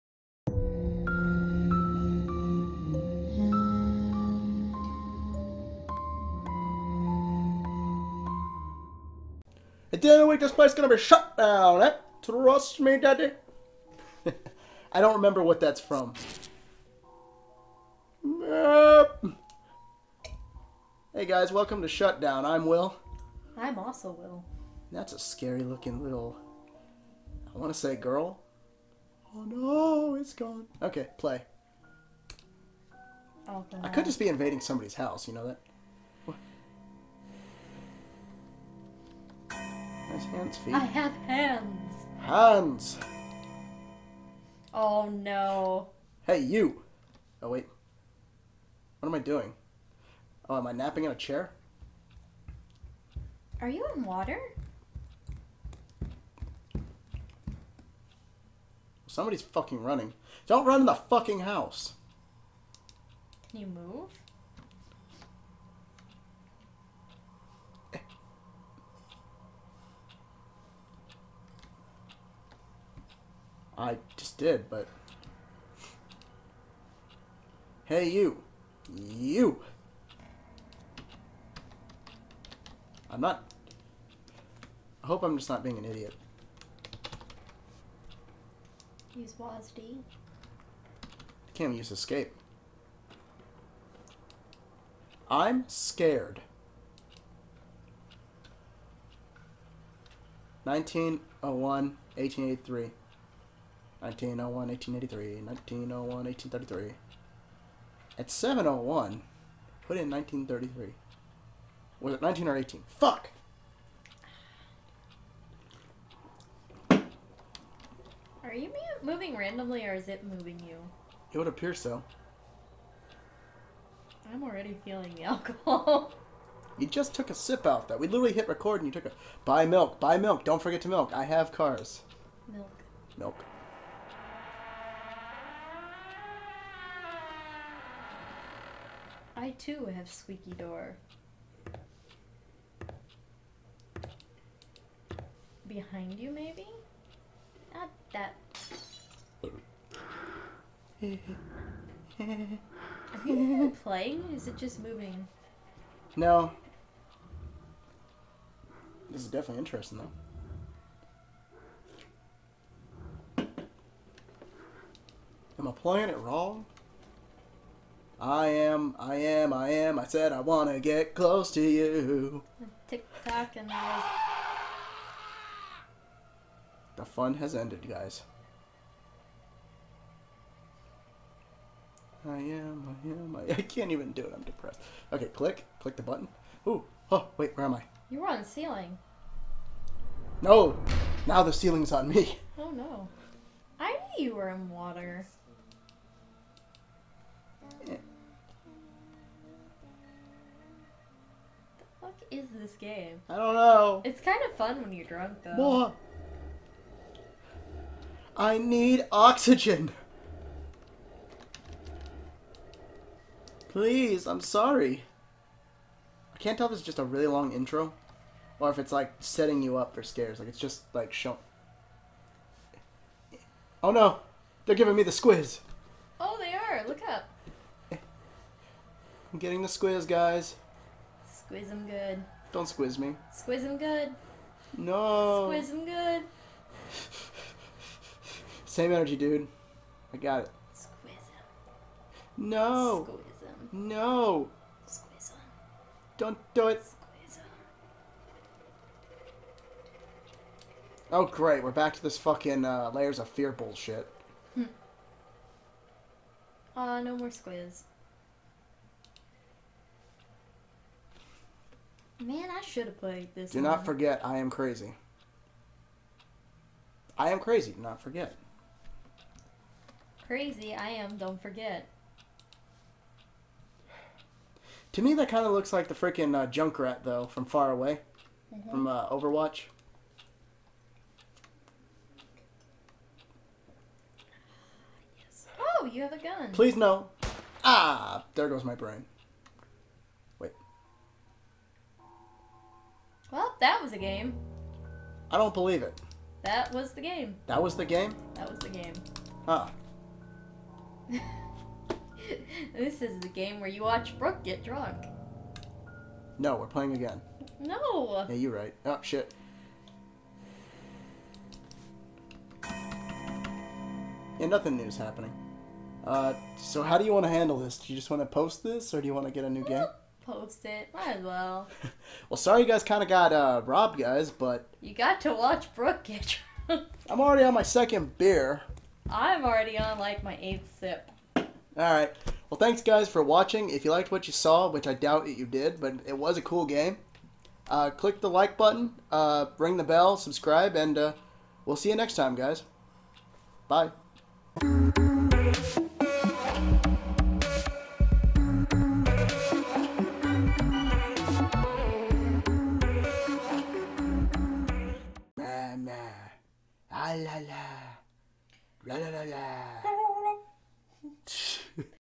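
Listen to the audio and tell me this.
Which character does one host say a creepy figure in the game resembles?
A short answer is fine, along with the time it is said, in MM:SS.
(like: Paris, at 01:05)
Junkrat, at 04:36.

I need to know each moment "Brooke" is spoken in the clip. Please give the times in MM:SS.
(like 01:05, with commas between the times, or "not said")
05:04, 05:25.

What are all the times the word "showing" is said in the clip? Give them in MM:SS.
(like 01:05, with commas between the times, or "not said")
03:41.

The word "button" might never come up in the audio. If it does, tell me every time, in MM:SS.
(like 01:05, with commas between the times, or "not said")
03:06, 05:38.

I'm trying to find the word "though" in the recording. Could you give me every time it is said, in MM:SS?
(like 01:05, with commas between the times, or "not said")
02:43, 03:25, 04:37.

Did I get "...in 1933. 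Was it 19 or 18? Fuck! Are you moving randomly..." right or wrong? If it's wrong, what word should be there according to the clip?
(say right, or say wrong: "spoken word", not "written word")
right.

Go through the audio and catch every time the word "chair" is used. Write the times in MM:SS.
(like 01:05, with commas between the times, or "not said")
00:51.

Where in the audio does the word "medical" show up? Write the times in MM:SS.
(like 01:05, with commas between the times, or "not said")
not said.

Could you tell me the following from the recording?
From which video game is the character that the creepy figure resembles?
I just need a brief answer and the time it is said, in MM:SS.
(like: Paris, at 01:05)
Overwatch, at 04:39.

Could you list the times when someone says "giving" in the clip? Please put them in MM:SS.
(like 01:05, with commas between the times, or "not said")
03:44.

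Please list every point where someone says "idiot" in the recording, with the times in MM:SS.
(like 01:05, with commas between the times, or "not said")
01:25.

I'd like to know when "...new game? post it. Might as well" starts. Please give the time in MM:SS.
05:19.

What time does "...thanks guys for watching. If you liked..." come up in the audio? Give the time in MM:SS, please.
05:32.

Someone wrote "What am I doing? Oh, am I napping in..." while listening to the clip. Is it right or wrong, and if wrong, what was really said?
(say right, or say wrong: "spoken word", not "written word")
right.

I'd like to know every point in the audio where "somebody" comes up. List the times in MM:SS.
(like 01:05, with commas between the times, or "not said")
00:34, 00:59.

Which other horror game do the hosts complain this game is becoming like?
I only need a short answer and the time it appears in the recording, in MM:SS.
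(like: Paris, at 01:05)
Layers of Fear, at 04:12.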